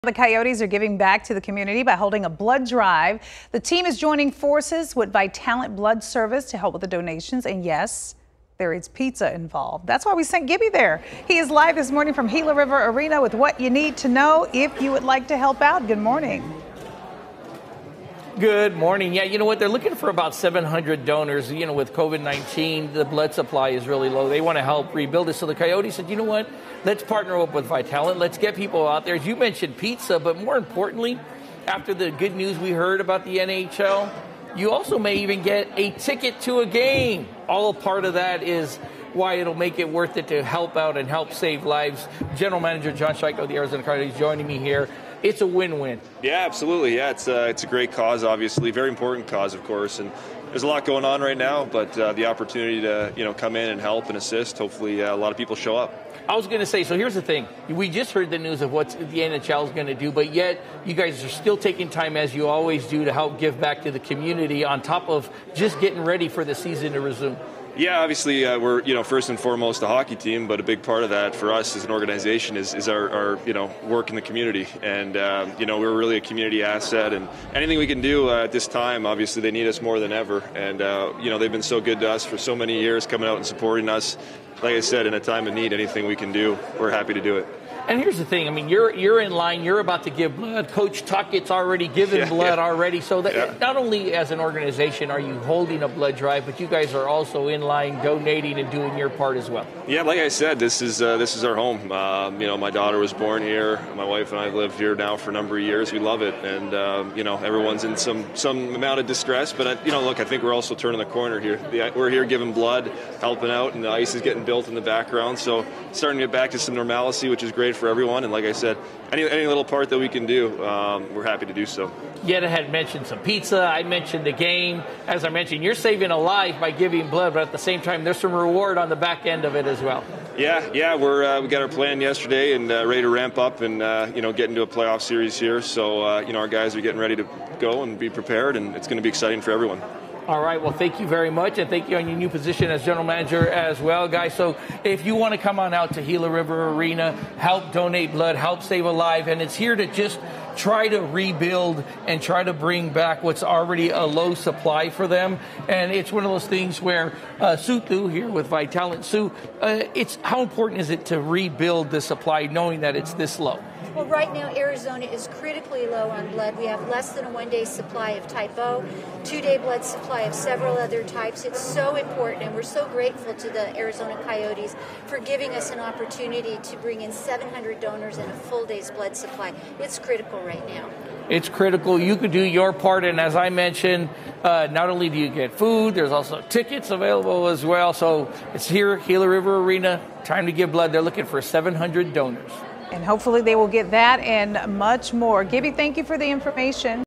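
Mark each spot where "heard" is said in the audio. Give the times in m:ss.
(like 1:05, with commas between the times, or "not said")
0:32, 0:58.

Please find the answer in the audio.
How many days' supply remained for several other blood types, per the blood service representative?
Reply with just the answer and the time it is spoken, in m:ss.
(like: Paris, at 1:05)
2, at 2:49.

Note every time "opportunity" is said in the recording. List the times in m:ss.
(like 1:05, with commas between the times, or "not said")
0:52, 2:55.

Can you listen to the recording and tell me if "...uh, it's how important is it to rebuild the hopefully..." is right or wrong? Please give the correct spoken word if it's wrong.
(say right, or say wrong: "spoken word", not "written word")
wrong: "supply", not "hopefully".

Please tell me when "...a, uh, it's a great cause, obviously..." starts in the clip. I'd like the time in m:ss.
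0:47.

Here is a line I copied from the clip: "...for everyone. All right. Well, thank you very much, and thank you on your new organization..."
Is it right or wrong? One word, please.
wrong.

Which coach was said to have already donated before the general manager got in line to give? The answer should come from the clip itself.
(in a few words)
Tocchet.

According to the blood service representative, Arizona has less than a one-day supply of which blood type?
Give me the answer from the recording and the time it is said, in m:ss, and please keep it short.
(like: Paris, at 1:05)
Type O, at 2:48.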